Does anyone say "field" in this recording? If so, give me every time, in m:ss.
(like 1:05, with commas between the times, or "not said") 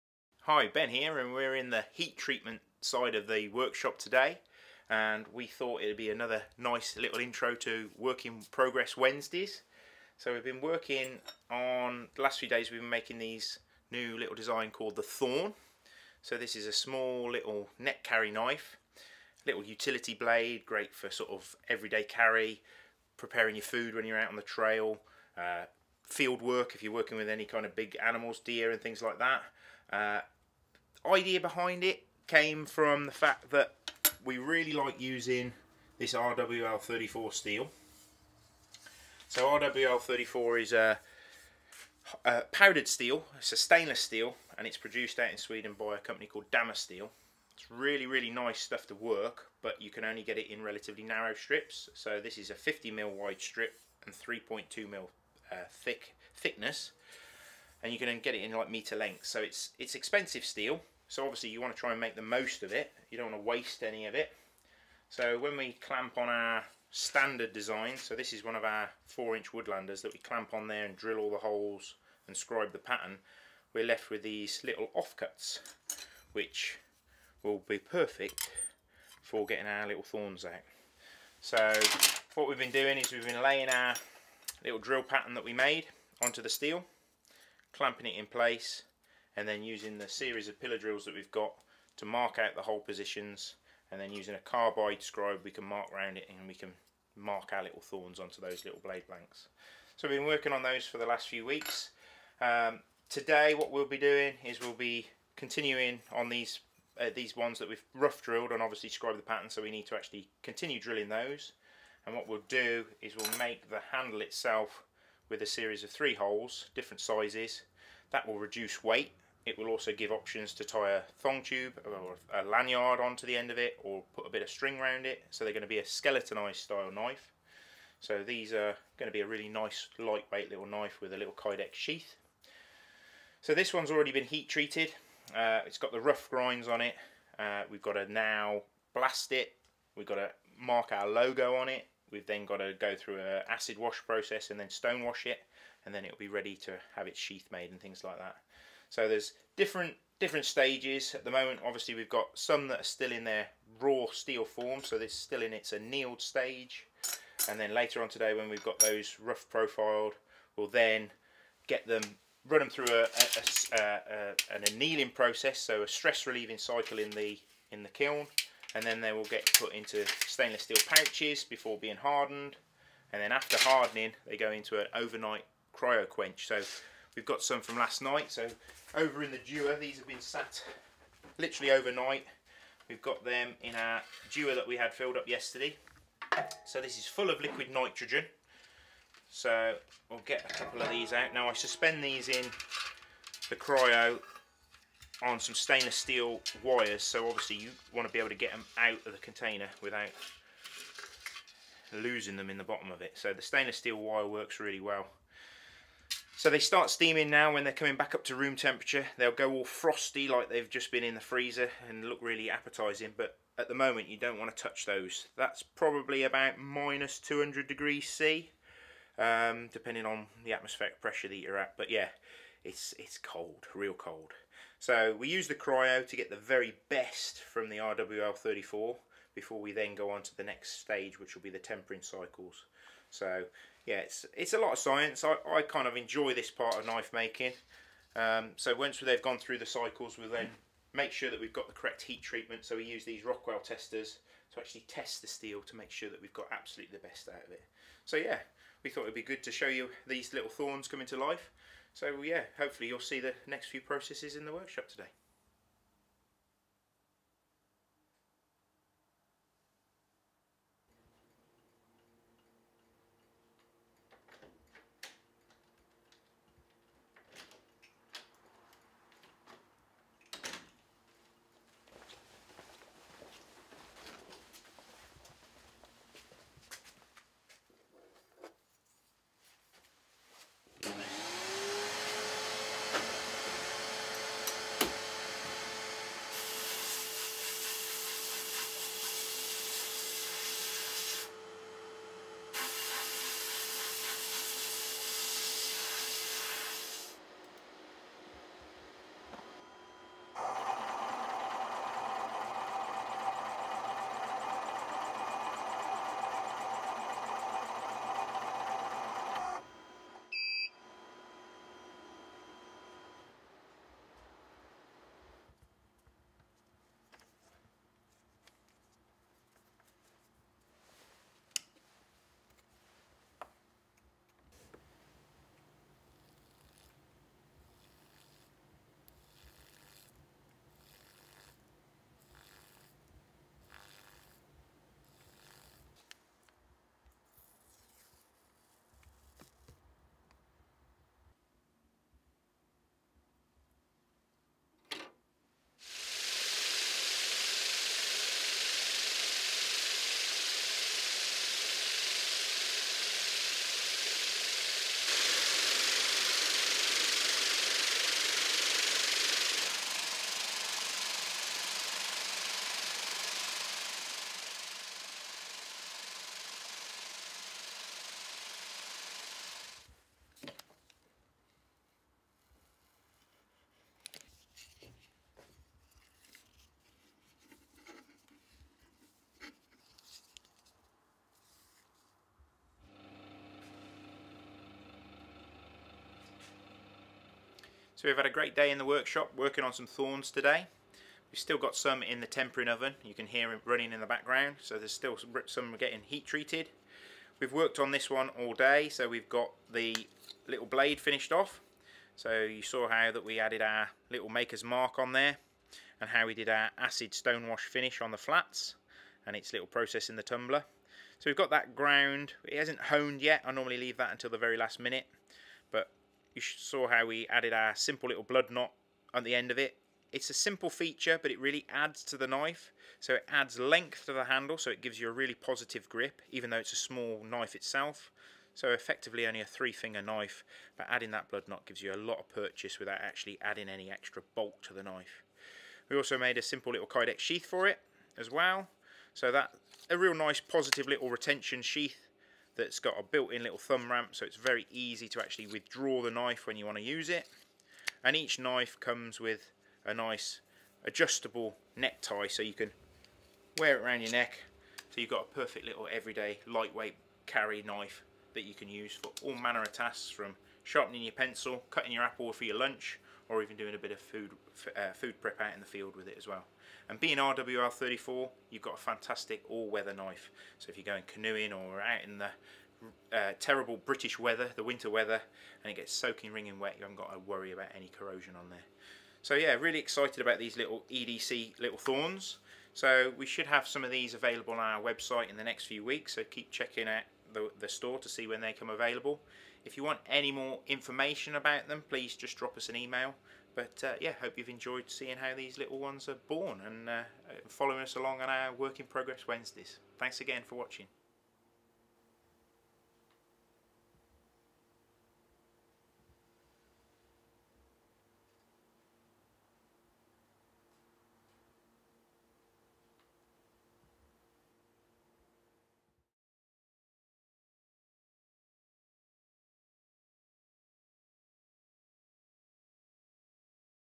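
0:26, 7:45.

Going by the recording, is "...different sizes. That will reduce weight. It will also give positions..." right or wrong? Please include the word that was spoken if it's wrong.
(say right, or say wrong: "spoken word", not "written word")
wrong: "options", not "positions".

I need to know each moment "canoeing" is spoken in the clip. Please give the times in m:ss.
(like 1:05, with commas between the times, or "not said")
7:51.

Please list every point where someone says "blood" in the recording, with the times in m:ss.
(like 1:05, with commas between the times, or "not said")
6:58, 7:11.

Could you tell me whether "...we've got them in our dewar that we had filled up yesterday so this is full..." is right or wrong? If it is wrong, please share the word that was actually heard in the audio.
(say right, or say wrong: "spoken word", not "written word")
right.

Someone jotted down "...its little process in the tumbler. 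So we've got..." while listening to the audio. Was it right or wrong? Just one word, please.
right.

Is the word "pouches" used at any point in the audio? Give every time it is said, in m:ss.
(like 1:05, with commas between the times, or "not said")
2:50.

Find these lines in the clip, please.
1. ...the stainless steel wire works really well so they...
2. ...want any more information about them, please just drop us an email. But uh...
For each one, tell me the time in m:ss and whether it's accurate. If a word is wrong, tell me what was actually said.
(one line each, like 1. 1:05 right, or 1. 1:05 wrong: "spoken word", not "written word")
1. 3:23 right
2. 8:09 right.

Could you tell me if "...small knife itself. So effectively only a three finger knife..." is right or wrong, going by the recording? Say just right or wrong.
right.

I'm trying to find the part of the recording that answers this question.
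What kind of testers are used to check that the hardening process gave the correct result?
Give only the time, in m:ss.
4:03.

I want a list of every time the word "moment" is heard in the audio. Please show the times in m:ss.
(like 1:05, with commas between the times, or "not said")
2:31, 3:33.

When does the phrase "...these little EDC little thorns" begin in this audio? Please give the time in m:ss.
8:00.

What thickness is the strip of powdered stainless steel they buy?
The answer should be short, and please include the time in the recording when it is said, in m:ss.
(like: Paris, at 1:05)
3.2mm, at 0:54.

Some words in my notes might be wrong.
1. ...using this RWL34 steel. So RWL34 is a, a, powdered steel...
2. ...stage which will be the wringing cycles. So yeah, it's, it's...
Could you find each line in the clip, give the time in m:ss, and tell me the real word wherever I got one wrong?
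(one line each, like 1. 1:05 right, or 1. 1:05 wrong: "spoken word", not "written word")
1. 0:35 right
2. 3:50 wrong: "tempering", not "wringing".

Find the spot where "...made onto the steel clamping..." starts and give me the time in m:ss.
1:25.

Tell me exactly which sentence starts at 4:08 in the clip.
So yeah, we thought it'd be good to show you these little thorns coming to life.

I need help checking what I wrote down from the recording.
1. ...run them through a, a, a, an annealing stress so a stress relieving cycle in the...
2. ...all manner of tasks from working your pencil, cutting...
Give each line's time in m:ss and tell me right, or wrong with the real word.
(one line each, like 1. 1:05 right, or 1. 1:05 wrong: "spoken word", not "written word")
1. 2:42 wrong: "process", not "stress"
2. 7:39 wrong: "sharpening", not "working".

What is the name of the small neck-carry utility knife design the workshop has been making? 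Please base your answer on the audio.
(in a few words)
Thorn.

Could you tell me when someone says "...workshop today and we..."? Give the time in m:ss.
0:03.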